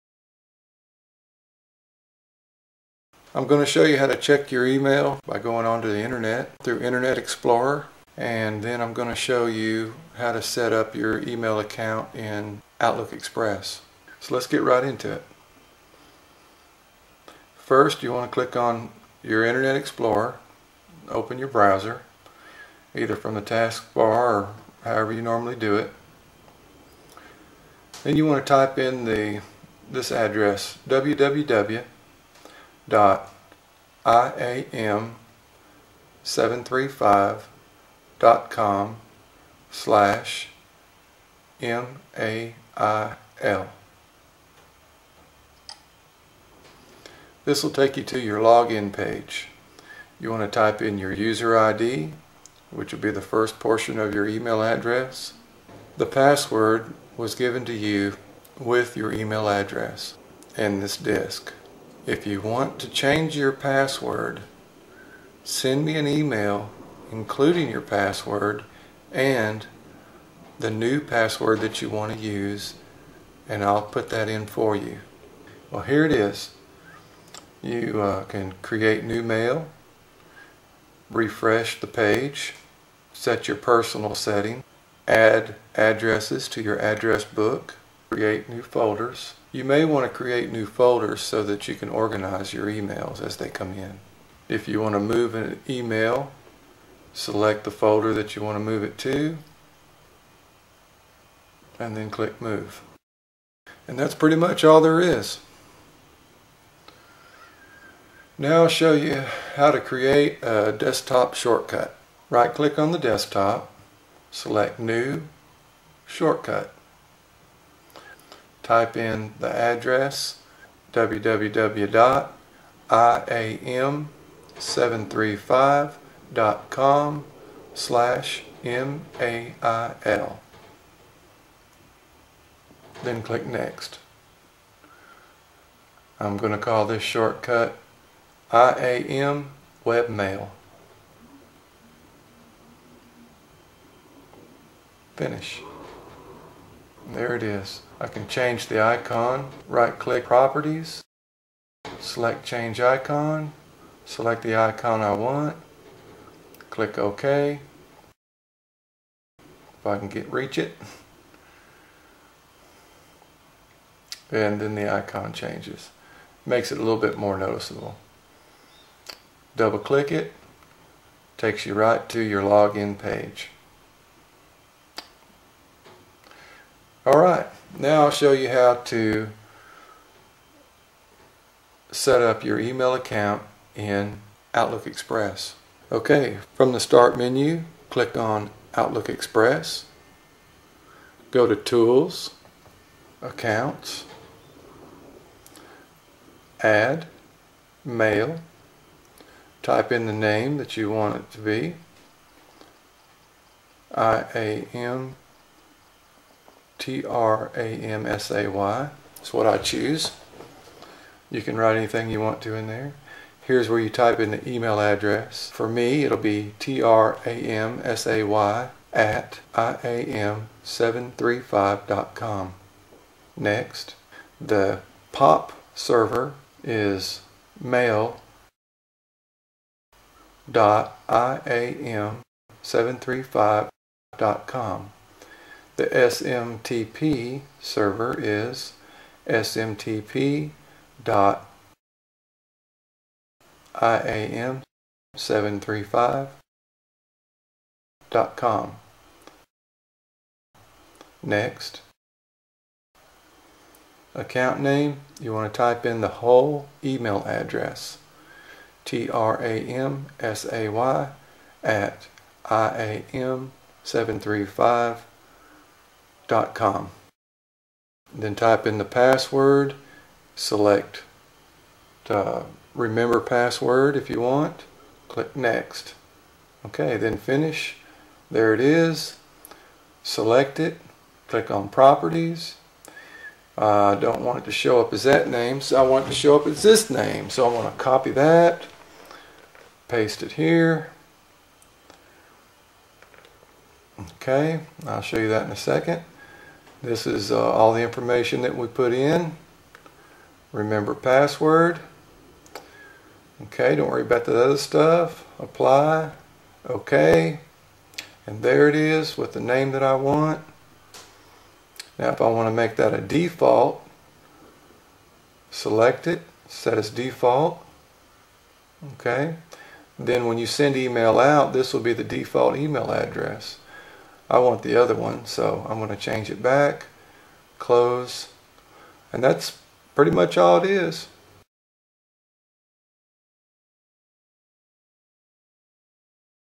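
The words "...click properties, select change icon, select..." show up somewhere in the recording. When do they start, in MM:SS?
02:29.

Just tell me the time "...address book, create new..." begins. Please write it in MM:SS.
01:26.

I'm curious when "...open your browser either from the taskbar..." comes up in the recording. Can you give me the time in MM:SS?
00:21.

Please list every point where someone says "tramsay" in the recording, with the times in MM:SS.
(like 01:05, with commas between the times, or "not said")
04:18.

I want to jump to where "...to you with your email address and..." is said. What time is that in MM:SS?
00:57.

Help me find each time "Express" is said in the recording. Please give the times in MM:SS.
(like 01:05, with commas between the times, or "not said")
00:13, 03:04, 03:09.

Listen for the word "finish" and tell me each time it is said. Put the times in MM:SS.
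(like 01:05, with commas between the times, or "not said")
02:25, 04:37.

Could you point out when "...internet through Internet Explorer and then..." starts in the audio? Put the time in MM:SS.
00:06.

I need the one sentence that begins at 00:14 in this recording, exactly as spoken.
So let's get right into it.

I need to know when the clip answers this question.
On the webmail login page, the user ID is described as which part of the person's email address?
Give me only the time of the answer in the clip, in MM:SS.
00:53.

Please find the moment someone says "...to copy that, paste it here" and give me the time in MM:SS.
04:47.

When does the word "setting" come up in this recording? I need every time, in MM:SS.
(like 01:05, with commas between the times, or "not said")
01:24.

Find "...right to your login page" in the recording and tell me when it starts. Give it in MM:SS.
02:51.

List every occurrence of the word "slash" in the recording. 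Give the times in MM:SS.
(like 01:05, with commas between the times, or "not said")
00:39, 02:07.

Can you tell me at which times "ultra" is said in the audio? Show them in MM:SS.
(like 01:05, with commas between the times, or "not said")
not said.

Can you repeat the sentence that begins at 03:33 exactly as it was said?
Here's where you type in the email address.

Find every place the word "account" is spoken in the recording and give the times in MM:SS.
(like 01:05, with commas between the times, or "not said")
00:11, 03:02, 03:13, 04:14.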